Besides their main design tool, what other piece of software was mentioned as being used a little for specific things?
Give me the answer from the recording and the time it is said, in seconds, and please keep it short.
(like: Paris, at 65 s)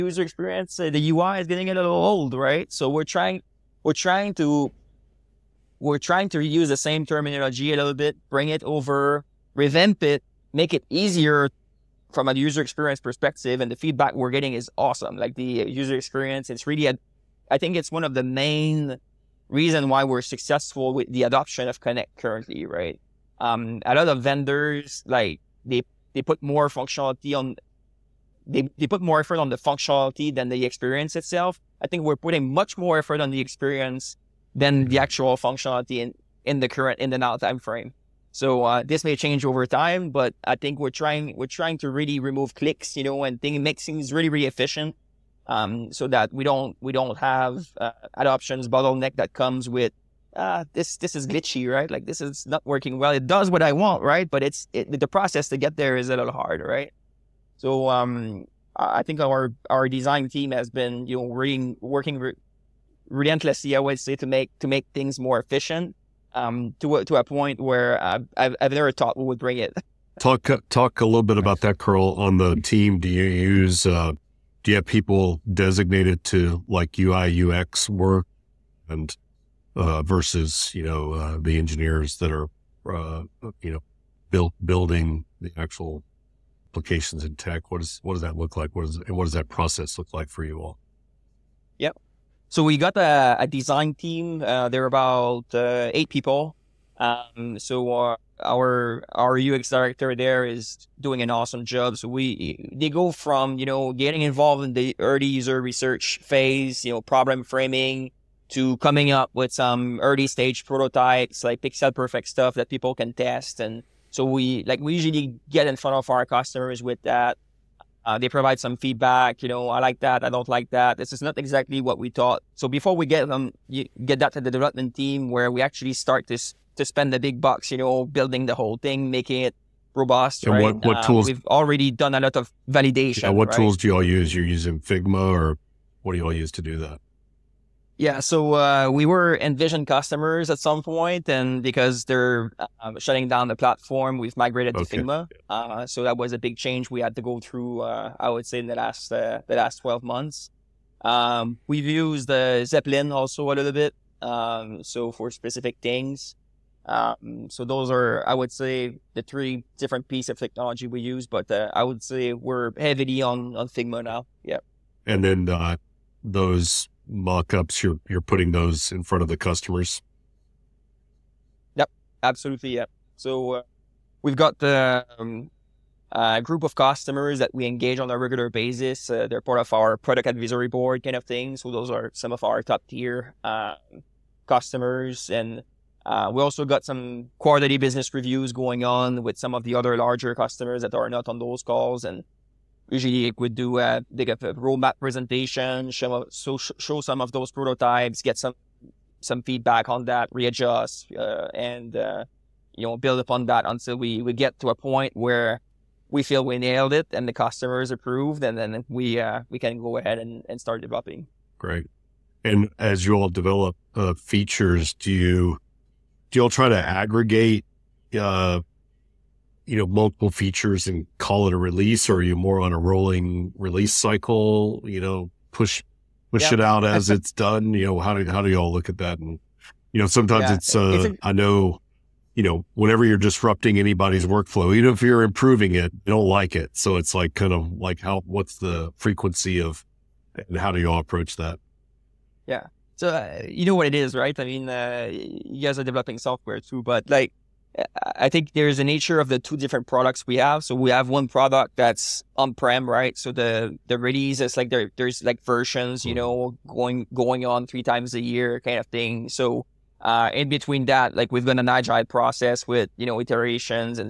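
Zeplin, at 152 s.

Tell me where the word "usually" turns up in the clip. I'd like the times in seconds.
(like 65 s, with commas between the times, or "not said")
114 s, 192 s.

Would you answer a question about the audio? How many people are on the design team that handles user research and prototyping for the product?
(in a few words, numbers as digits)
8.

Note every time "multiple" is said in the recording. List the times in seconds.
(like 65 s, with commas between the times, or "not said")
219 s.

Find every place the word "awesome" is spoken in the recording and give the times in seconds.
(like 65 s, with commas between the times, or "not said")
14 s, 101 s.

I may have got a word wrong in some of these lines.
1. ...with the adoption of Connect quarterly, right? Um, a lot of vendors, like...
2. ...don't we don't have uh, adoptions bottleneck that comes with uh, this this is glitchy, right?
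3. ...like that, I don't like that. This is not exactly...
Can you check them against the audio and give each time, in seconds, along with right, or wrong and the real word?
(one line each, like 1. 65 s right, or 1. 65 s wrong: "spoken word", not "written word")
1. 20 s wrong: "currently", not "quarterly"
2. 46 s right
3. 119 s right.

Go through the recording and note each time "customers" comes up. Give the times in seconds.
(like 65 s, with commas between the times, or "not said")
116 s, 139 s, 169 s, 176 s, 184 s, 190 s, 207 s.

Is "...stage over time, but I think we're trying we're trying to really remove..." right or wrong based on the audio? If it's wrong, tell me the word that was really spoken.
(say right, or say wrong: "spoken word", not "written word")
wrong: "change", not "stage".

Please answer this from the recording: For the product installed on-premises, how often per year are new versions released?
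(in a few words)
3 times a year.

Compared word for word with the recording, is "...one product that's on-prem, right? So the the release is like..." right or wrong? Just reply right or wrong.
right.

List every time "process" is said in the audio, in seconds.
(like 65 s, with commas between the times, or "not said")
55 s, 89 s, 262 s.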